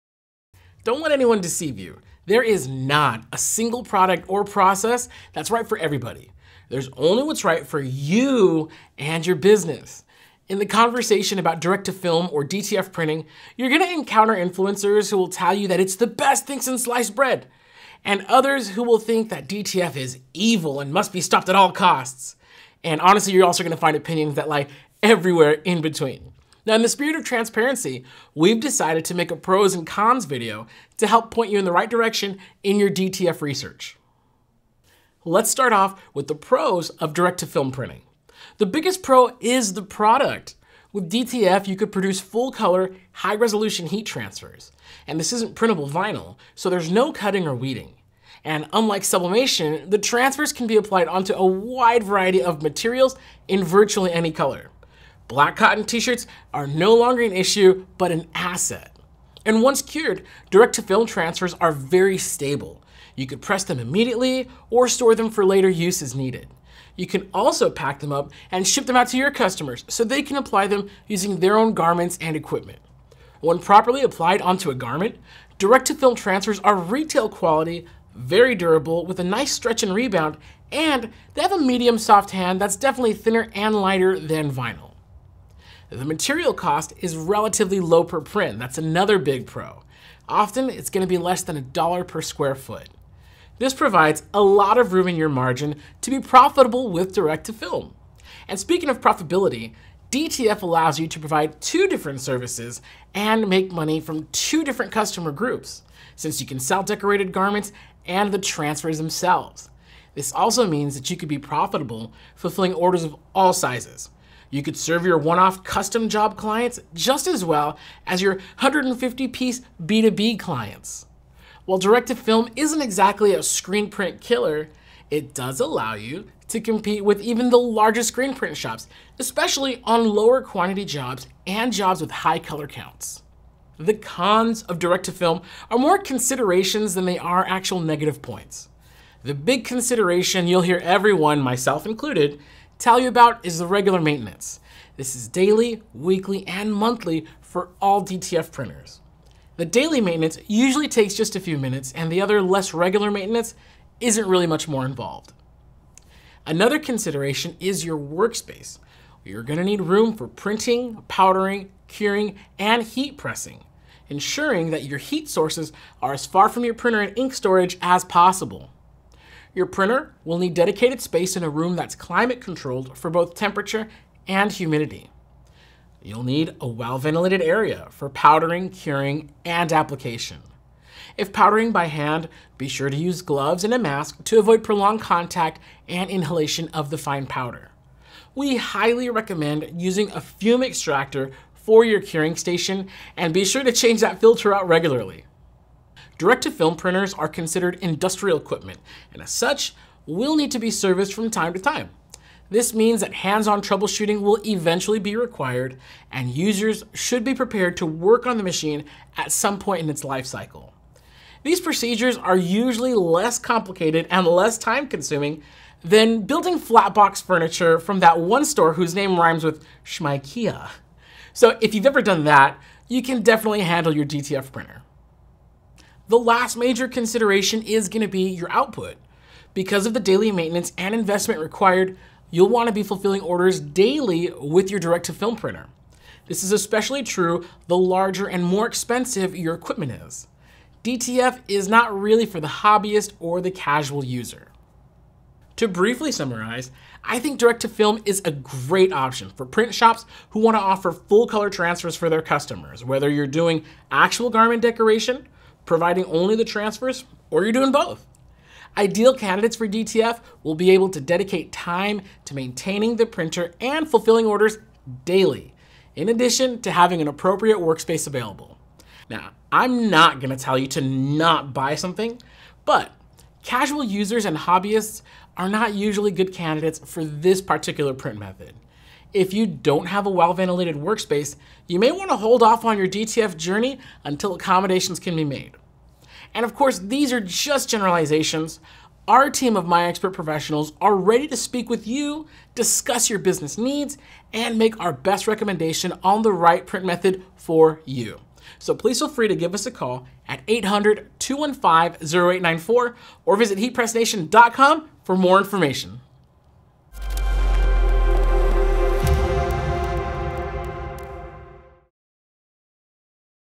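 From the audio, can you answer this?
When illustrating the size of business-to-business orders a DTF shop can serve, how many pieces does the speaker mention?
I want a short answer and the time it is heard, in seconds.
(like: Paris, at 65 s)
150, at 118 s.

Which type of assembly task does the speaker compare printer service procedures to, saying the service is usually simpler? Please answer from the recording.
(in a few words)
flatbox furniture.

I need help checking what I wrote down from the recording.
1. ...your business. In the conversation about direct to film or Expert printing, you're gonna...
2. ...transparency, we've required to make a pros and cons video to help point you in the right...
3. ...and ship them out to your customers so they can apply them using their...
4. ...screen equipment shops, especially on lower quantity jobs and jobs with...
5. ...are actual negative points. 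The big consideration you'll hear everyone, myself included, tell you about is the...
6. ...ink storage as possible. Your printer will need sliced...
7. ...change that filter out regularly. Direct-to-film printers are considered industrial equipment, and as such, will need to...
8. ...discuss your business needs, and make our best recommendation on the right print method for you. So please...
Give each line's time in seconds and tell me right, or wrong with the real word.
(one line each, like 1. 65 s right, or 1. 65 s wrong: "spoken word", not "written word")
1. 9 s wrong: "DTF", not "Expert"
2. 27 s wrong: "decided", not "required"
3. 68 s right
4. 128 s wrong: "print", not "equipment"
5. 137 s right
6. 167 s wrong: "dedicated", not "sliced"
7. 193 s right
8. 292 s right.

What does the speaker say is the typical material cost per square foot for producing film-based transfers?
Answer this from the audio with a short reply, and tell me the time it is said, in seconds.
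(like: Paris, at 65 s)
less than $1, at 91 s.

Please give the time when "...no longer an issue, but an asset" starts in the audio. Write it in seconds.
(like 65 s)
56 s.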